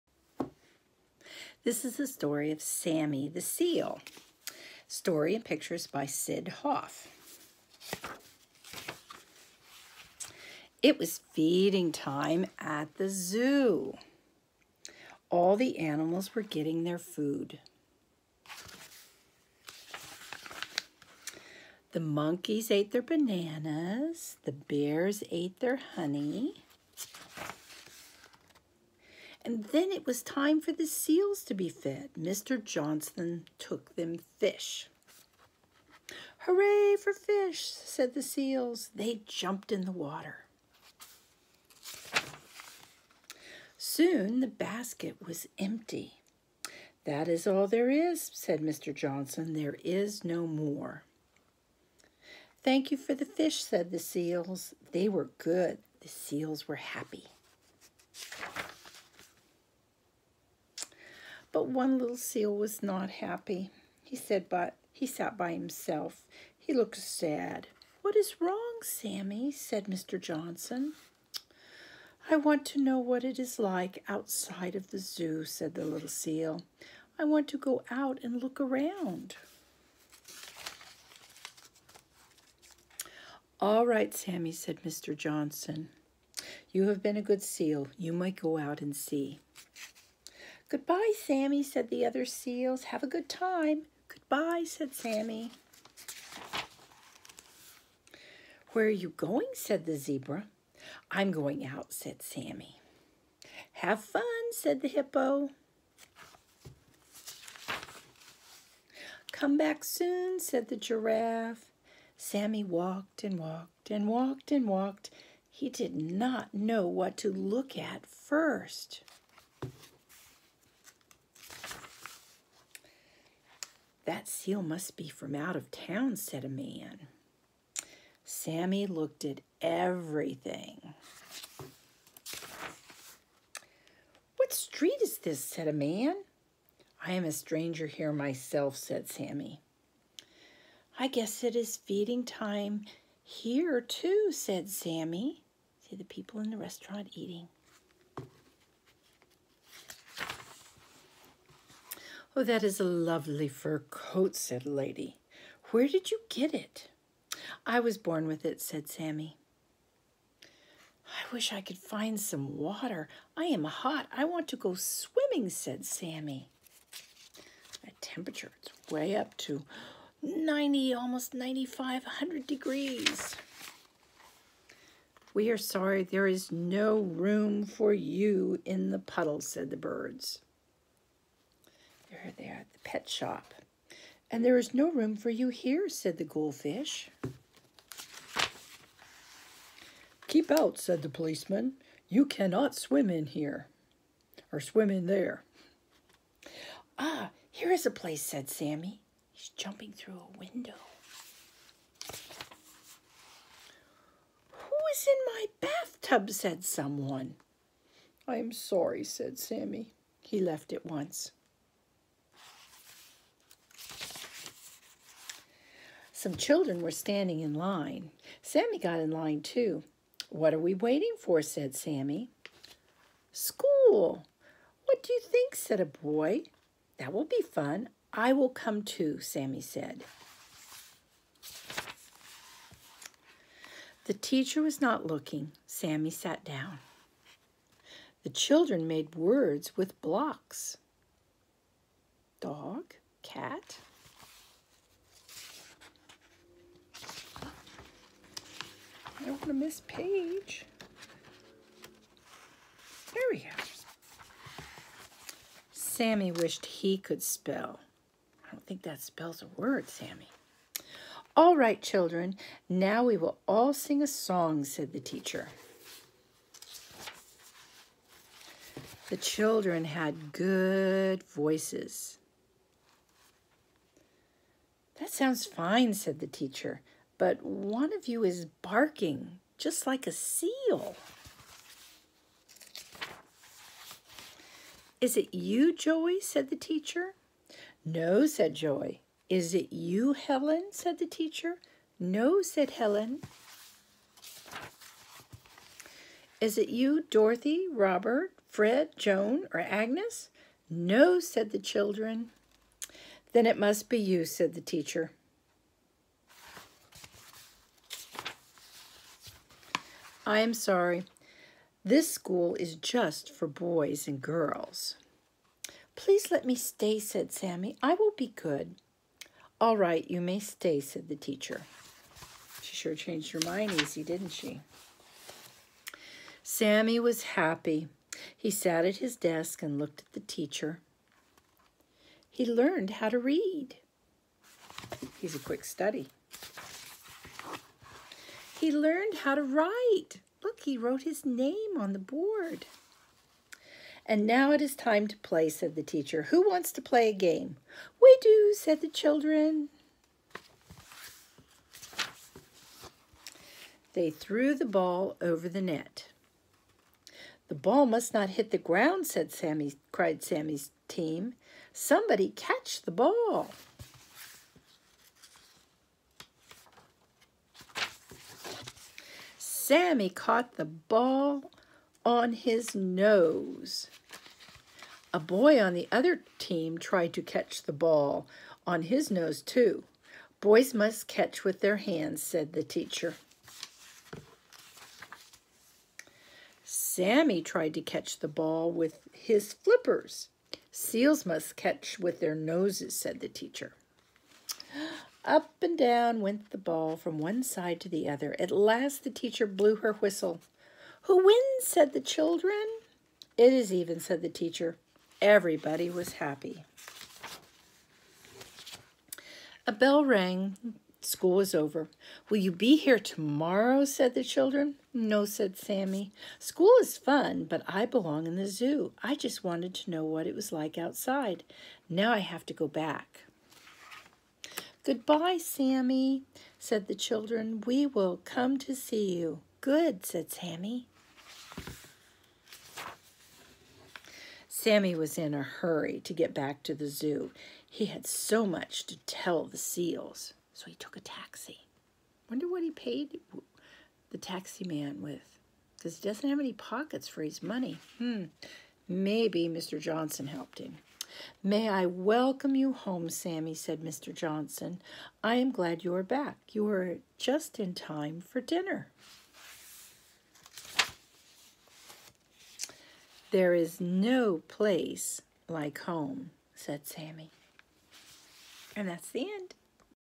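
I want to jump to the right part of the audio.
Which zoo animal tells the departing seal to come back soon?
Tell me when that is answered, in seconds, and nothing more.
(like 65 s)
109 s.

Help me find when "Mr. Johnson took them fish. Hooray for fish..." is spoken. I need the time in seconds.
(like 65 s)
32 s.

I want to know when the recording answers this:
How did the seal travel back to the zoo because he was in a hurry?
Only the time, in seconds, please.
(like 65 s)
440 s.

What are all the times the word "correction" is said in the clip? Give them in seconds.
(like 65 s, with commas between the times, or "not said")
not said.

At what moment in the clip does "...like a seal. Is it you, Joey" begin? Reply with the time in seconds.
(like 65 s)
279 s.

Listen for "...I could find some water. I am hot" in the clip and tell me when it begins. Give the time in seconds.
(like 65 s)
161 s.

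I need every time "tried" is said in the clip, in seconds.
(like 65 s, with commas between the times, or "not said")
376 s, 387 s.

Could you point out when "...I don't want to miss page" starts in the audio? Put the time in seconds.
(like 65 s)
249 s.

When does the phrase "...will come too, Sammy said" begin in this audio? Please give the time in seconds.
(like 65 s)
228 s.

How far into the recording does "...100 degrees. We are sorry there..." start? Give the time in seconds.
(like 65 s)
172 s.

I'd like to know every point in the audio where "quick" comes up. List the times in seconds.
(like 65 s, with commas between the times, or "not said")
335 s.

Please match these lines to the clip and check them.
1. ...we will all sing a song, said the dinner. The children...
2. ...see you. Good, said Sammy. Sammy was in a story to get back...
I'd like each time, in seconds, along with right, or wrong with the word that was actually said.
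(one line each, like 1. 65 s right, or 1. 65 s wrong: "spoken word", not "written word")
1. 263 s wrong: "teacher", not "dinner"
2. 428 s wrong: "hurry", not "story".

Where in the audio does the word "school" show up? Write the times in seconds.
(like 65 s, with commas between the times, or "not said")
223 s, 312 s, 411 s, 416 s.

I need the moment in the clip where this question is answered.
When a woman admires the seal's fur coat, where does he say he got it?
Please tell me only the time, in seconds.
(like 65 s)
157 s.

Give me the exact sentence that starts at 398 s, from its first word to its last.
At last the teacher blew her whistle.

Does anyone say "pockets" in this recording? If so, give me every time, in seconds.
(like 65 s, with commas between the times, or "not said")
446 s.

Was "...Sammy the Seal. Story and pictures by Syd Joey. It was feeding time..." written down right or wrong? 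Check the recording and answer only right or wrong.
wrong.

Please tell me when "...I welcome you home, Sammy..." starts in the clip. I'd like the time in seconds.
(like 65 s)
451 s.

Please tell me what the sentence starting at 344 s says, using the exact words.
And now it is time to play, said the teacher.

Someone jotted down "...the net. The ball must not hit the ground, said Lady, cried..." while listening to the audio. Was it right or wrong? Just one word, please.
wrong.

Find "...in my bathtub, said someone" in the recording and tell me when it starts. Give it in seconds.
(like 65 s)
205 s.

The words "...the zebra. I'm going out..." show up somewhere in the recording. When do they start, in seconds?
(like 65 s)
99 s.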